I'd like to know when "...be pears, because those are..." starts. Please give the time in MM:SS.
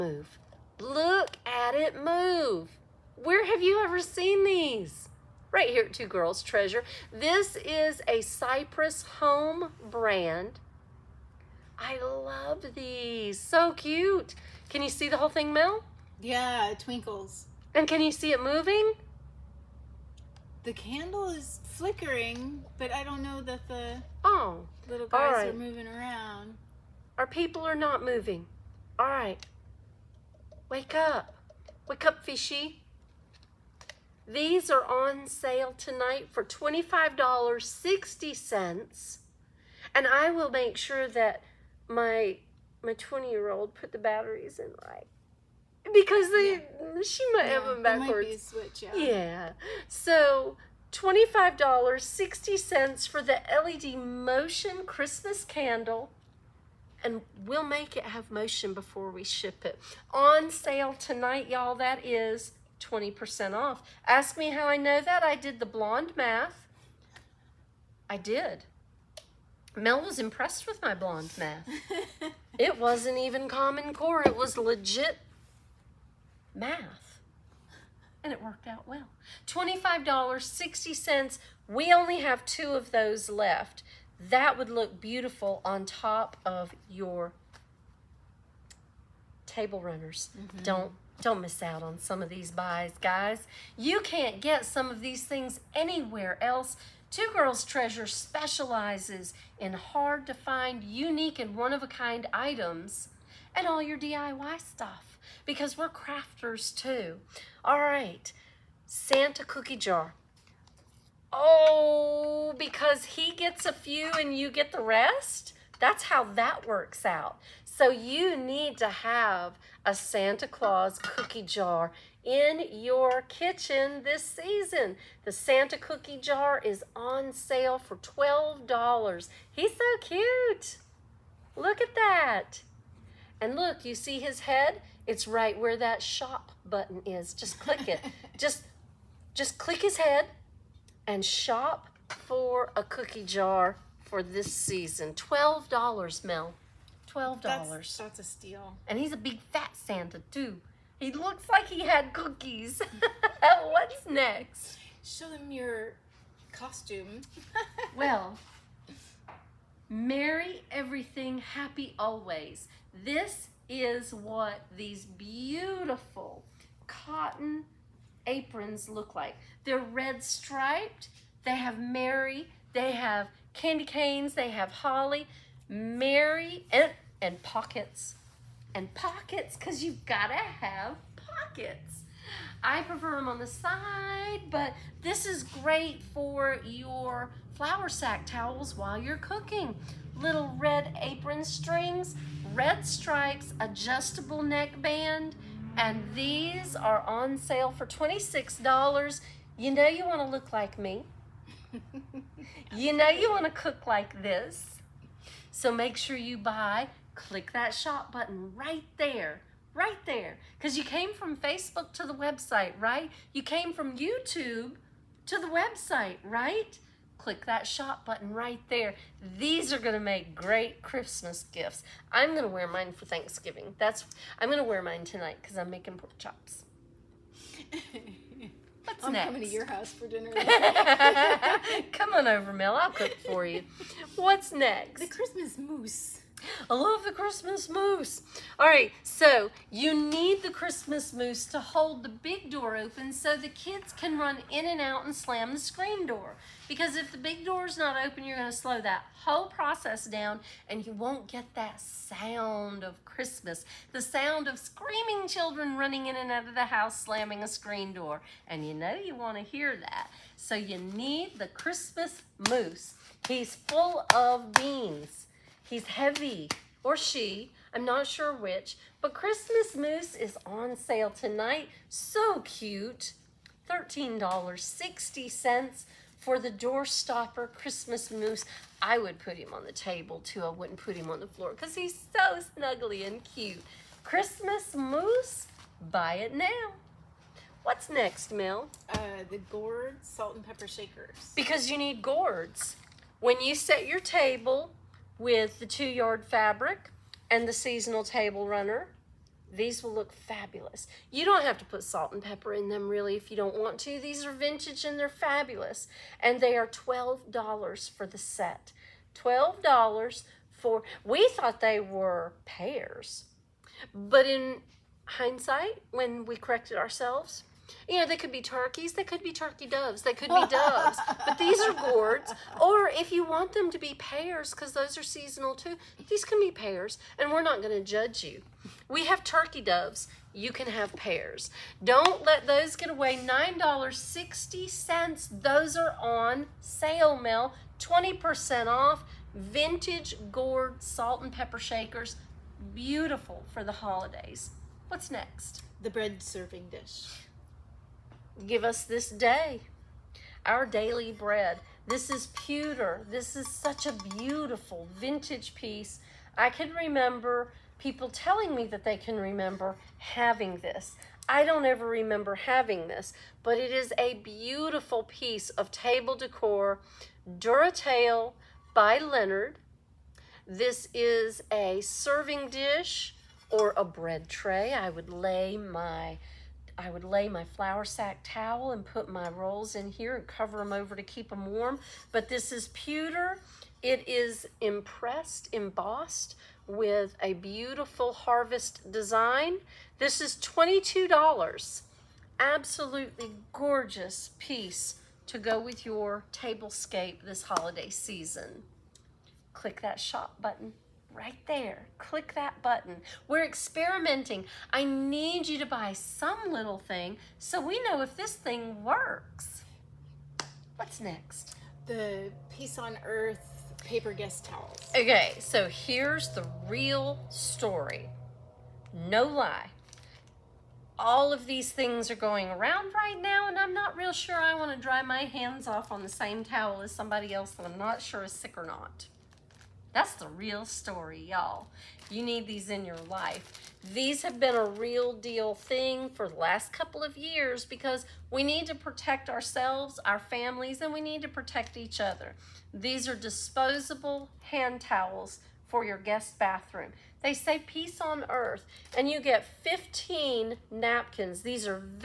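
05:23.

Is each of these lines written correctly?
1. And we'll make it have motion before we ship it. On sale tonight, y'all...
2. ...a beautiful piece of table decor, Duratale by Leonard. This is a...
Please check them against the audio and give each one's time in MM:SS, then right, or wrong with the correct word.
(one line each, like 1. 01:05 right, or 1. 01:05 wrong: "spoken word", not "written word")
1. 00:57 right
2. 06:03 right.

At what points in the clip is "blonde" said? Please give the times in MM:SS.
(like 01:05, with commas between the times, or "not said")
01:05, 01:10.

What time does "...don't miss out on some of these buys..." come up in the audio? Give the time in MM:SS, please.
01:31.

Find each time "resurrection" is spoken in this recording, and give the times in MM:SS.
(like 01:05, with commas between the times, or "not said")
not said.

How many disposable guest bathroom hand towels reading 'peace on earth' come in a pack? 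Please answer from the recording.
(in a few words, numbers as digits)
15.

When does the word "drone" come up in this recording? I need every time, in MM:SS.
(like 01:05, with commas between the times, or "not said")
not said.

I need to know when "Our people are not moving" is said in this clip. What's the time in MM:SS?
00:27.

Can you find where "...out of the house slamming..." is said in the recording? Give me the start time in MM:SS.
04:16.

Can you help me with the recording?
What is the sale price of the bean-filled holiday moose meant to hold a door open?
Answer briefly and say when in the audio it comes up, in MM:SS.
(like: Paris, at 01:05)
$13.60, at 04:33.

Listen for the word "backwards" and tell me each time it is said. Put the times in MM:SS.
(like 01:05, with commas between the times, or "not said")
00:47.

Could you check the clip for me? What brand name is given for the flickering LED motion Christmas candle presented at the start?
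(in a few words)
Cypress Home.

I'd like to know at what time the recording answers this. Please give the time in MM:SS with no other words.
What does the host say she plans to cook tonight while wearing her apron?
03:45.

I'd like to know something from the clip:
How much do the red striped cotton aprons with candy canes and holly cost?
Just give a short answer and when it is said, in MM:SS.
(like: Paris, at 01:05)
$26, at 03:17.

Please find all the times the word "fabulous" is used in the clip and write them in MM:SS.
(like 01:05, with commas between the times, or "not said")
05:00, 05:05.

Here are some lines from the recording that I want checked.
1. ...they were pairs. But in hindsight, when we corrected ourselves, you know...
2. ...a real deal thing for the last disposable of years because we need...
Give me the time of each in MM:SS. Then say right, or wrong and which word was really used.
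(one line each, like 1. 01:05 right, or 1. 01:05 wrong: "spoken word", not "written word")
1. 05:11 right
2. 07:14 wrong: "couple", not "disposable".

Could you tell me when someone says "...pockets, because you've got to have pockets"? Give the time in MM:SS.
02:58.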